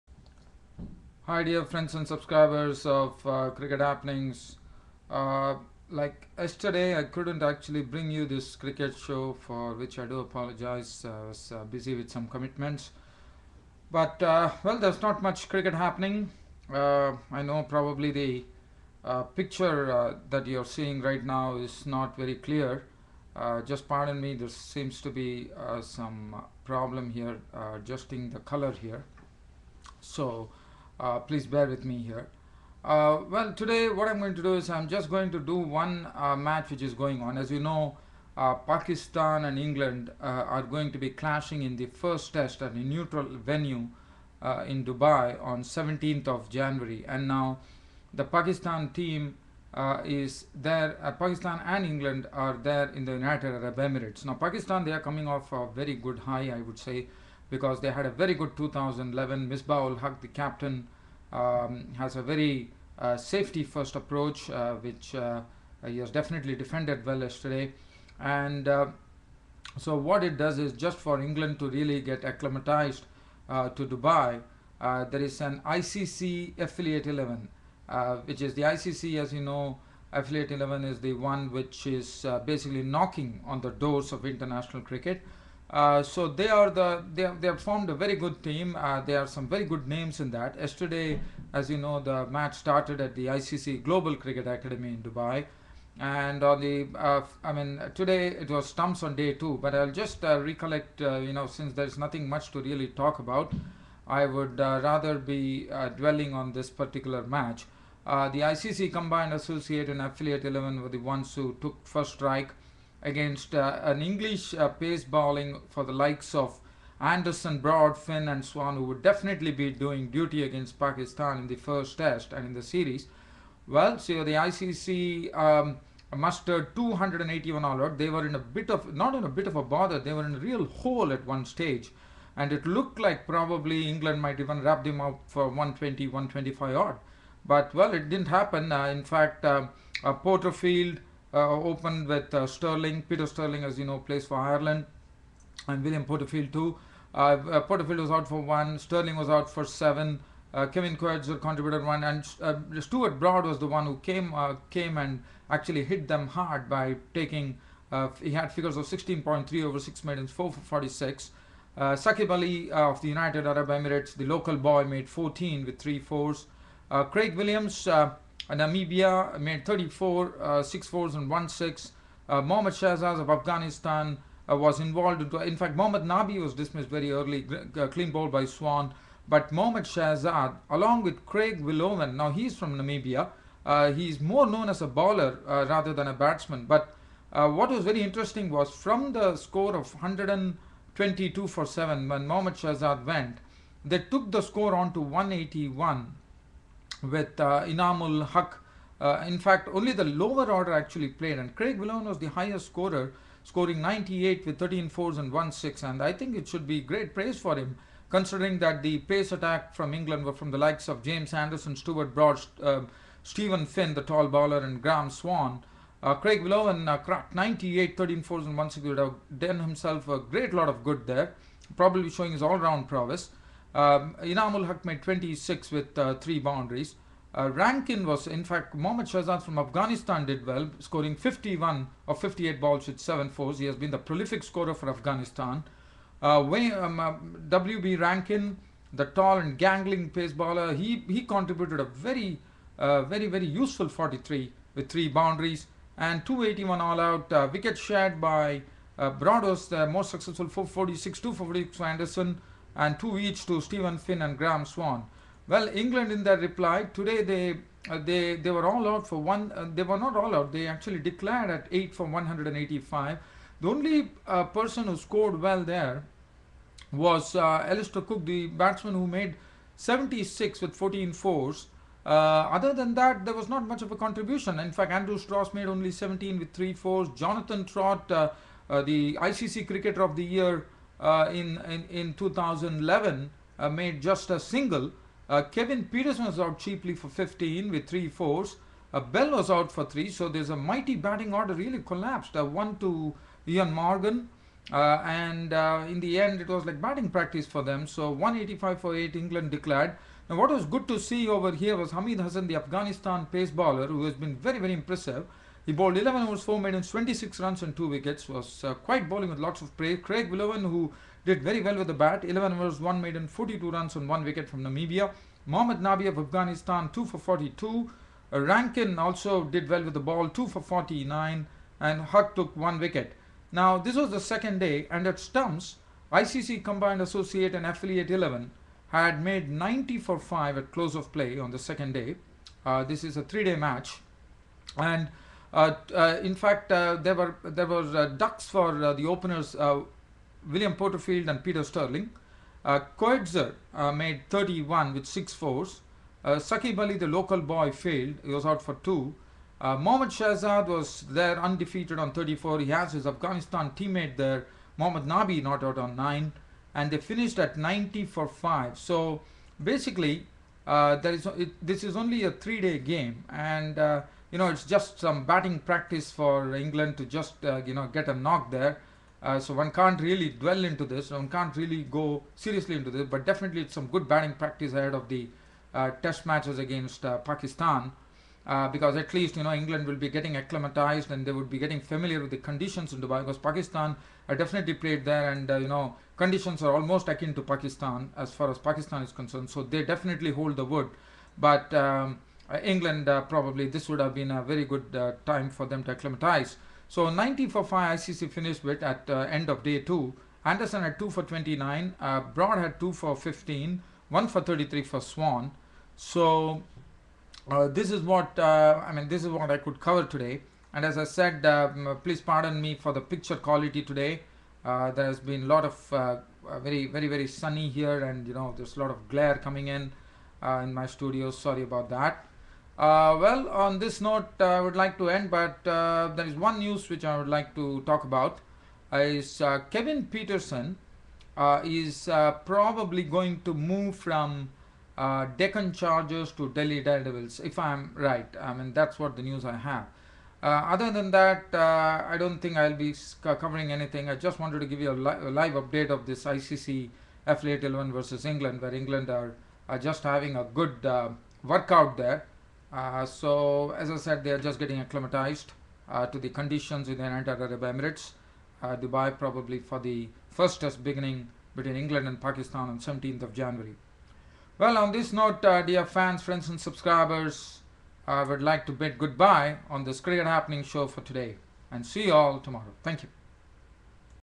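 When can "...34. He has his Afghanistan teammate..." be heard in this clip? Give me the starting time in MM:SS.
05:52.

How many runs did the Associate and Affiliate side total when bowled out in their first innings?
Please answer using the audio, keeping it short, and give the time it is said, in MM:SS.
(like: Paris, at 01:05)
281, at 02:06.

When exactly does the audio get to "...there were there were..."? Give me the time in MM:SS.
05:36.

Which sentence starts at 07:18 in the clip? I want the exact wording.
I mean, that's what the news I have.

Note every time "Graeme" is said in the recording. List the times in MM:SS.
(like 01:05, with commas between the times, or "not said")
03:34, 04:14.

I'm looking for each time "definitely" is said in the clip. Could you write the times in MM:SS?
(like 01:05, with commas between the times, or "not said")
01:06, 01:59, 06:13, 06:24, 06:29.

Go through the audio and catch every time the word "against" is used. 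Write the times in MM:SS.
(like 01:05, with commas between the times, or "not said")
01:53, 02:00, 06:16.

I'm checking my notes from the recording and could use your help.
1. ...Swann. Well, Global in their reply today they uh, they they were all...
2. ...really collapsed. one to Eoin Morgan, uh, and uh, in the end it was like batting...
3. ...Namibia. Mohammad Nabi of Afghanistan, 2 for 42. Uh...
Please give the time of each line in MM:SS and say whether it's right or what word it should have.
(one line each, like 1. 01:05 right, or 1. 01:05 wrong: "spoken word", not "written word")
1. 04:14 wrong: "England", not "Global"
2. 04:51 right
3. 05:14 right.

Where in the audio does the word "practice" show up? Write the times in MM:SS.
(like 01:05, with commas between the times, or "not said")
04:57, 06:05, 06:14.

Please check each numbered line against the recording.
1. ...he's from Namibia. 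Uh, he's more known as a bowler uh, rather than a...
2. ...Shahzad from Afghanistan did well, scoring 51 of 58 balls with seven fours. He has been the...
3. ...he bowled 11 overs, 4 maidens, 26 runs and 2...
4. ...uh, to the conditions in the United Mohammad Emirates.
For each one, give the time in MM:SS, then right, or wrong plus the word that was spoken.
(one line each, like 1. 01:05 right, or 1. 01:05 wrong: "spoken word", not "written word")
1. 03:02 right
2. 03:49 right
3. 05:05 right
4. 07:35 wrong: "Arab", not "Mohammad".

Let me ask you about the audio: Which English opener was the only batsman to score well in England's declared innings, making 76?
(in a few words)
Alastair Cook.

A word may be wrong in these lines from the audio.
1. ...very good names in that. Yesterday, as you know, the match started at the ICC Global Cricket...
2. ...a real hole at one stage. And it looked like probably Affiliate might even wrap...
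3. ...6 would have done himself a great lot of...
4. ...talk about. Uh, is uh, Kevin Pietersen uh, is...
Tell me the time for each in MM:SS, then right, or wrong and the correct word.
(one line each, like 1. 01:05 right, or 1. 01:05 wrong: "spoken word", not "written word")
1. 01:29 right
2. 02:10 wrong: "England", not "Affiliate"
3. 03:38 right
4. 07:07 right.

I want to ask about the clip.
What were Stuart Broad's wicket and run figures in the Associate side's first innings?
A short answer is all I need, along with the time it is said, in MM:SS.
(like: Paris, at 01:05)
4 for 46, at 02:40.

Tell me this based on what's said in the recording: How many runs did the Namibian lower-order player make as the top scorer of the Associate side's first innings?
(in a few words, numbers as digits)
98.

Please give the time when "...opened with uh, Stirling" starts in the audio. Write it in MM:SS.
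02:21.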